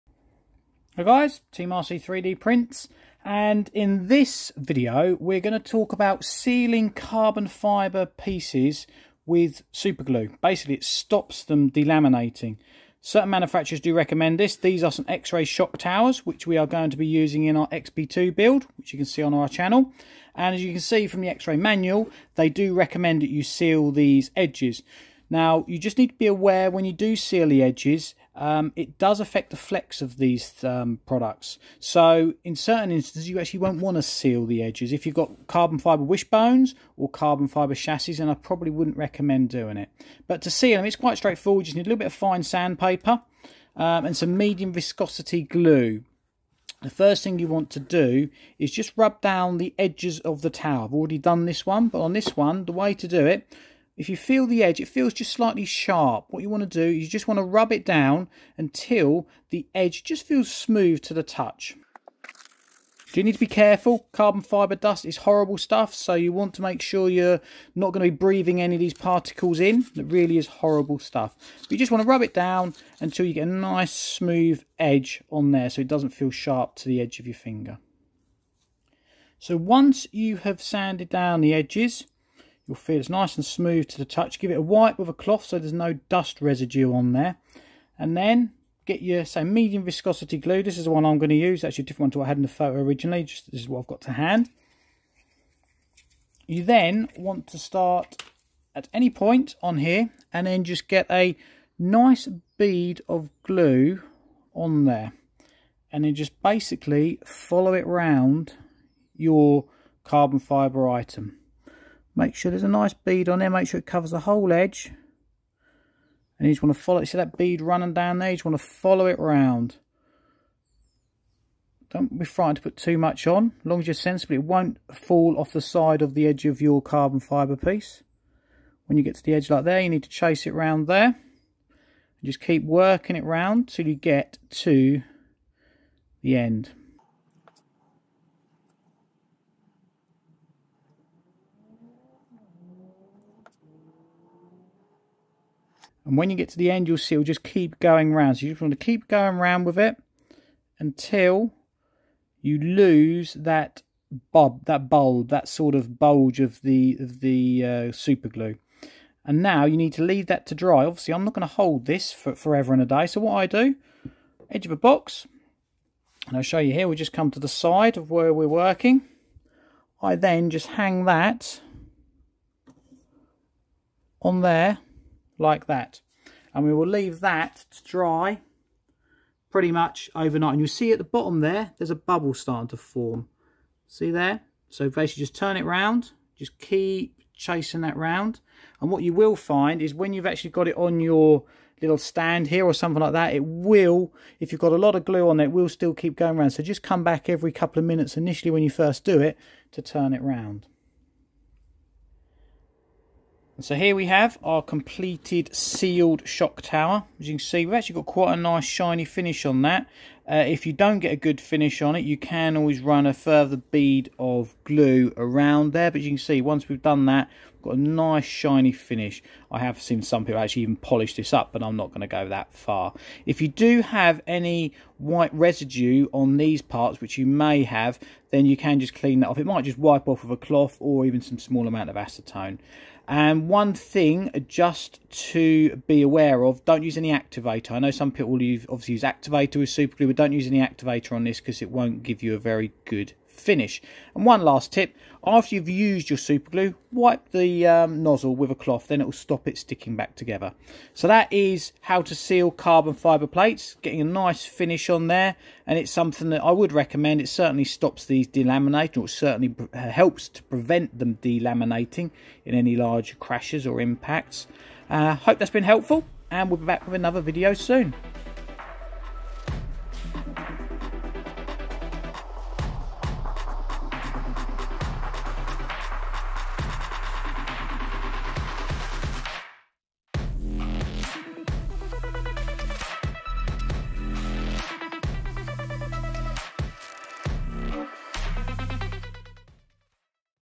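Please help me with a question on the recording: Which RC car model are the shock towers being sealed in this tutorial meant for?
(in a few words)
XB2.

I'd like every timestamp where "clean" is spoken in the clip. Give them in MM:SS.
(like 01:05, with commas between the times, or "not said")
03:48.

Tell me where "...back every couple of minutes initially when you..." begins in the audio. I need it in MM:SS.
03:17.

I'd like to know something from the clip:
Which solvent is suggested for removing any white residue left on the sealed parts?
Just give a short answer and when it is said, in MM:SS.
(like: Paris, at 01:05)
Acetone, at 03:51.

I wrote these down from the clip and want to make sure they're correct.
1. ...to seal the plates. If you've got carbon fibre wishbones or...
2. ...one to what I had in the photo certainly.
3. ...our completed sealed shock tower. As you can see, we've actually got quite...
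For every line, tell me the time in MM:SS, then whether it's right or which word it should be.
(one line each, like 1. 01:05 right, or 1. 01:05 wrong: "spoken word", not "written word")
1. 00:33 wrong: "edges", not "plates"
2. 01:32 wrong: "originally", not "certainly"
3. 03:24 right.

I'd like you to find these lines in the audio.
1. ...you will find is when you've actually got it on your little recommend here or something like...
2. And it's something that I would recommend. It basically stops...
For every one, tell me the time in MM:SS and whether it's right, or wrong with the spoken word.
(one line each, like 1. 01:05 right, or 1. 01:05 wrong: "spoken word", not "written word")
1. 03:09 wrong: "stand", not "recommend"
2. 04:15 wrong: "certainly", not "basically".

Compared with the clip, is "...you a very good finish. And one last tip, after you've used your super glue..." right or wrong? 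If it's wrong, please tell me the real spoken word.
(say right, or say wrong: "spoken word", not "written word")
right.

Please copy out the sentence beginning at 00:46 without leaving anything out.
The first thing you want to do is just rub down the edges of the tower.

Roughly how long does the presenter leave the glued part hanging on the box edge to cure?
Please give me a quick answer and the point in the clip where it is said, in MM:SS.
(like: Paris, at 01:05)
Overnight, at 02:59.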